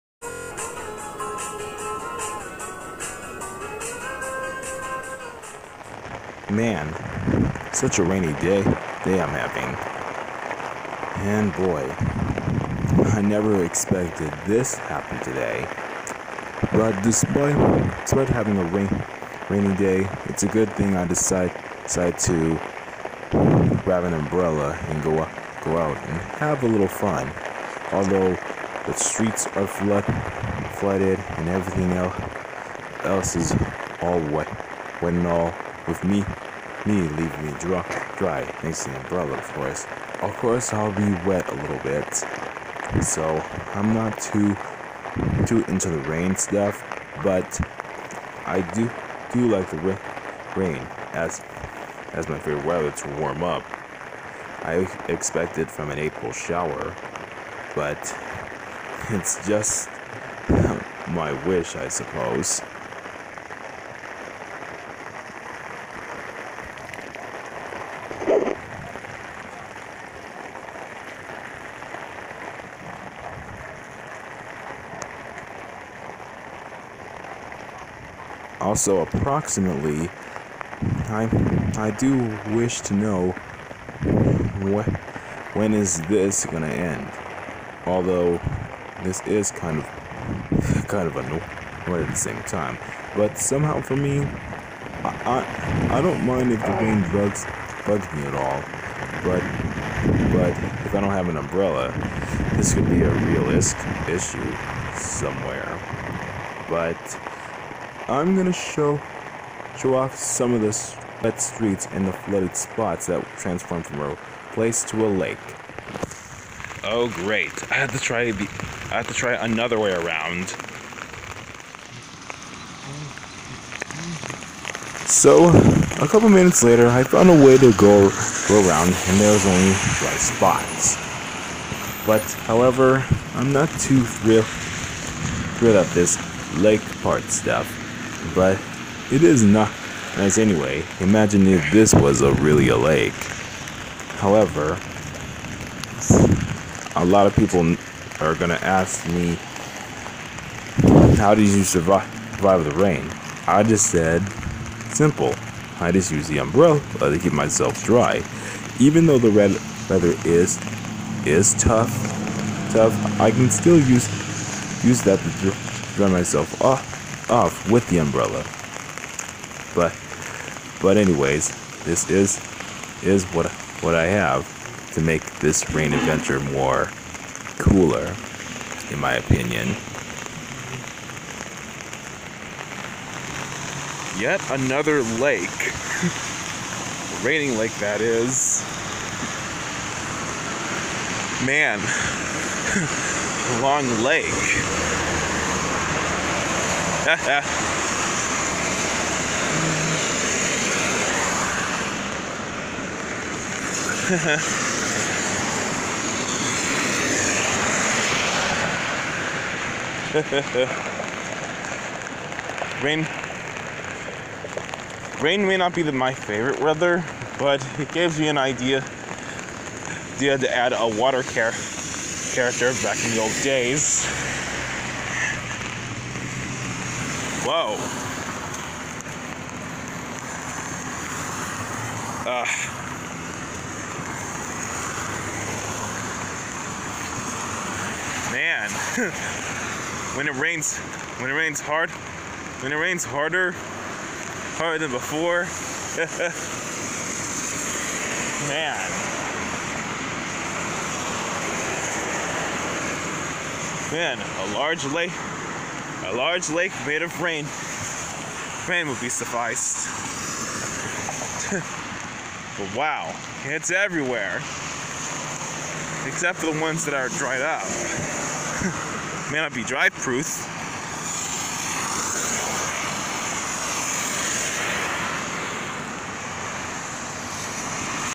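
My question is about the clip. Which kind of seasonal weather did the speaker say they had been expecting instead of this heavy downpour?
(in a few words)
April shower.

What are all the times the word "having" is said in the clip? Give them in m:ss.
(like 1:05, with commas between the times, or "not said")
0:09, 0:18.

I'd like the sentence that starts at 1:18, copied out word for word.
Also, approximately, I I do wish to know what when is this gonna end?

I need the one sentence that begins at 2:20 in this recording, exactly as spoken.
Imagine if this was a really a lake.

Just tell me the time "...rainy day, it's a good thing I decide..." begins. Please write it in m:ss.
0:19.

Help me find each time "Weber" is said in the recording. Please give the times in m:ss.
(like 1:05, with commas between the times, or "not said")
not said.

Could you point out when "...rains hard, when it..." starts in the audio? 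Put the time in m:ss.
4:01.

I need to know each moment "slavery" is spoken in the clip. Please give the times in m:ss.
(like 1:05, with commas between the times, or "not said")
not said.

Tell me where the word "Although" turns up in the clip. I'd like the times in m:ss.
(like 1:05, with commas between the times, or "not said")
0:27, 1:27.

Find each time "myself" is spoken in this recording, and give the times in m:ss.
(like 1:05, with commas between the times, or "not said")
2:37, 2:46.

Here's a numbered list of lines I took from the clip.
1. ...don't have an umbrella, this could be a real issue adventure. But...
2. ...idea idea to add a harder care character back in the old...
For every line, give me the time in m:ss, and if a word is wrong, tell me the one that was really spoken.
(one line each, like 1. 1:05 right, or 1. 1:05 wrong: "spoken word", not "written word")
1. 1:41 wrong: "somewhere", not "adventure"
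2. 3:38 wrong: "water", not "harder".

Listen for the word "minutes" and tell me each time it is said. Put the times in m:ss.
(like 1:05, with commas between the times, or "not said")
2:06.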